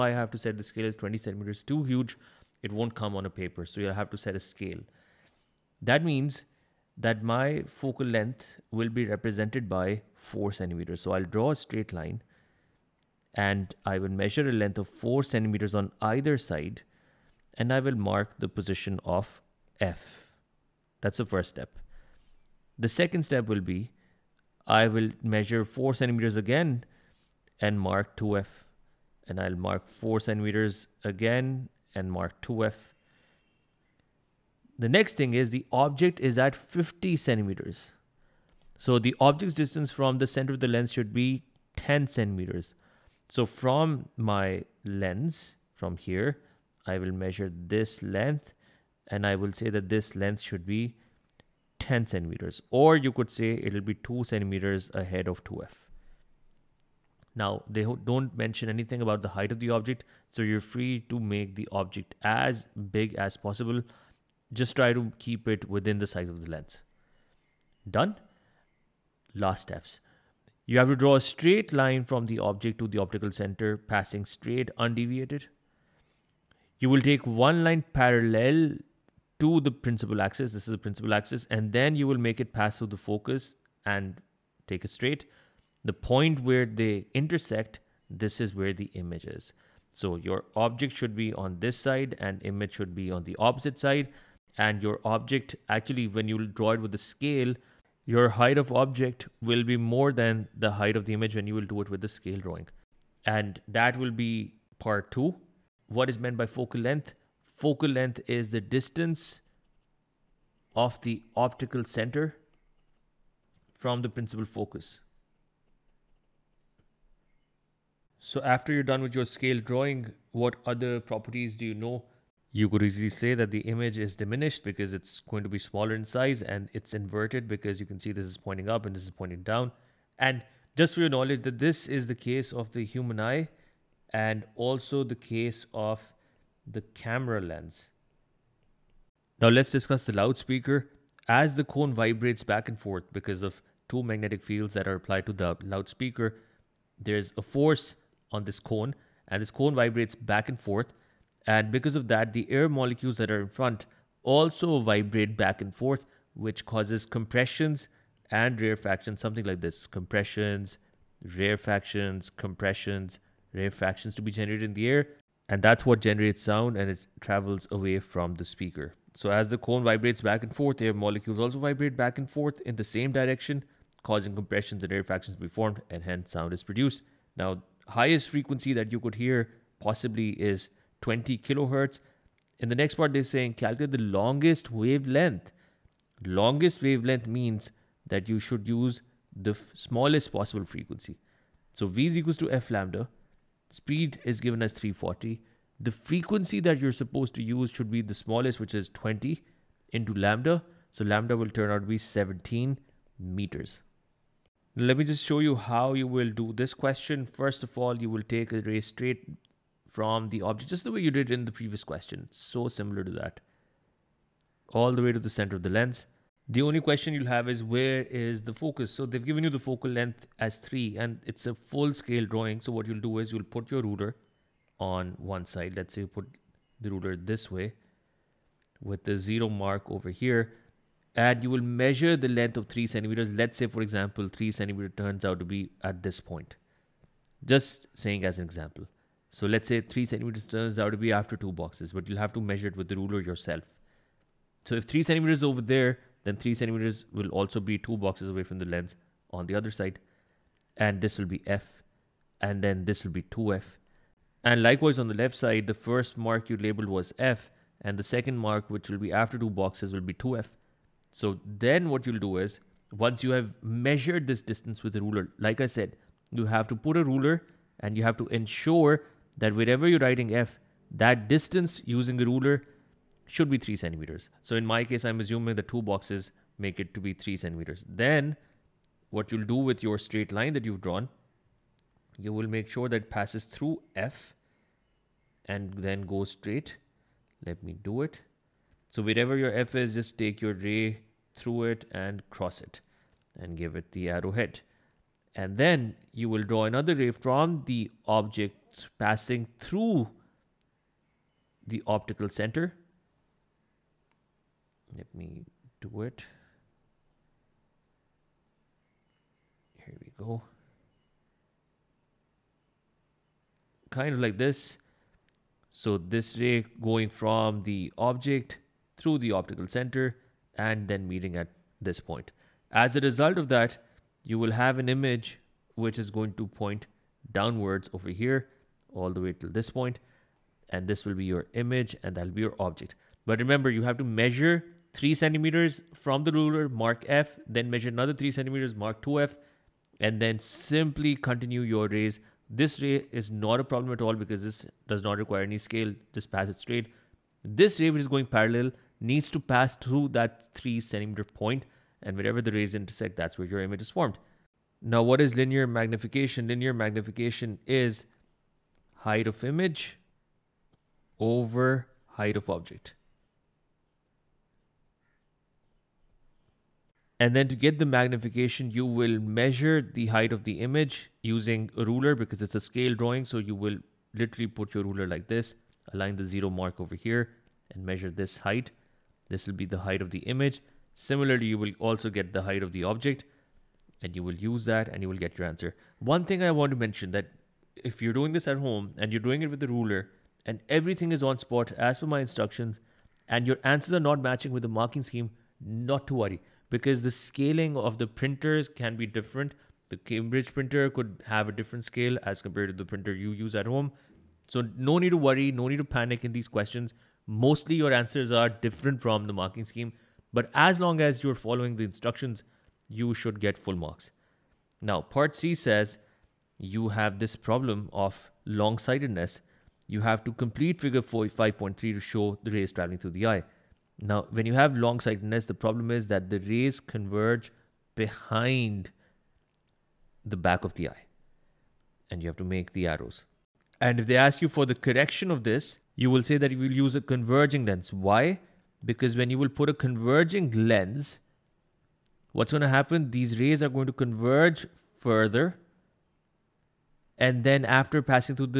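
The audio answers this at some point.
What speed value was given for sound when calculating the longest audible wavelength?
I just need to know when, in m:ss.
3:14.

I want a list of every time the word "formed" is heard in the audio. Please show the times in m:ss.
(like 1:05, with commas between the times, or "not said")
2:55, 5:53.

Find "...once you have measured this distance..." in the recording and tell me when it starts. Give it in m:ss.
4:23.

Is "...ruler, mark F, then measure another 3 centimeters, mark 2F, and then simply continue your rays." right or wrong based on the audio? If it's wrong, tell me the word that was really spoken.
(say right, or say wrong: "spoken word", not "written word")
right.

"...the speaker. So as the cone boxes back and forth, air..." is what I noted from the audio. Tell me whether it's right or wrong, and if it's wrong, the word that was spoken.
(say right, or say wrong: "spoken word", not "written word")
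wrong: "vibrates", not "boxes".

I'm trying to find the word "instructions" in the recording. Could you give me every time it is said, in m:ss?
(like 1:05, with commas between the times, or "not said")
6:32, 6:51.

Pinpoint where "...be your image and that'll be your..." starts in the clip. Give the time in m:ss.
5:31.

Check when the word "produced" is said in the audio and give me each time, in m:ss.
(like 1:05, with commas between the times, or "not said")
2:56.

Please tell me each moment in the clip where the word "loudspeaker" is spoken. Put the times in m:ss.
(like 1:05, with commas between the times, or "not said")
2:20, 2:25.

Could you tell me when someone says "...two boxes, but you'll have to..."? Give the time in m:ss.
4:01.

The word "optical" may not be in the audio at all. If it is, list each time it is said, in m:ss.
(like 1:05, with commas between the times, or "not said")
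1:12, 1:51, 5:01, 5:19.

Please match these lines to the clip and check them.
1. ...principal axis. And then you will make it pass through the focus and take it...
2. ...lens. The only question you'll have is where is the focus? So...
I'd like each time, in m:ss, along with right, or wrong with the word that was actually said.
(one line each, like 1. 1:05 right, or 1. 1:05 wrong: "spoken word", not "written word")
1. 1:20 right
2. 3:35 right.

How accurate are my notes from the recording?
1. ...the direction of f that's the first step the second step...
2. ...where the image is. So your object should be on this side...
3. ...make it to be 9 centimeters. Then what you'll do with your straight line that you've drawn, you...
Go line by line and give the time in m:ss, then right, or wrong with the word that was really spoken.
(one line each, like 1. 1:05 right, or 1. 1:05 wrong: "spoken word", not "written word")
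1. 0:18 wrong: "position", not "direction"
2. 1:28 right
3. 4:36 wrong: "3", not "9".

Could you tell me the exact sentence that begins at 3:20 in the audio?
So lambda will turn out to be 17 meters.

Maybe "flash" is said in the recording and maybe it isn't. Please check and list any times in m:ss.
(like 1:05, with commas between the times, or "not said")
not said.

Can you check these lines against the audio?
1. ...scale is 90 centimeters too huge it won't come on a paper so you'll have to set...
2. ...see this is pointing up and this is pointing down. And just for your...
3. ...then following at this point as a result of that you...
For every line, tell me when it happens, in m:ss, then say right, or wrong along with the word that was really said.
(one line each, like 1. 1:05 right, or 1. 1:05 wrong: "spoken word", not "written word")
1. 0:00 wrong: "20", not "90"
2. 2:07 right
3. 5:20 wrong: "meeting", not "following".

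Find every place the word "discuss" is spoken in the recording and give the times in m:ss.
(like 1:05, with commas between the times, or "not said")
2:19.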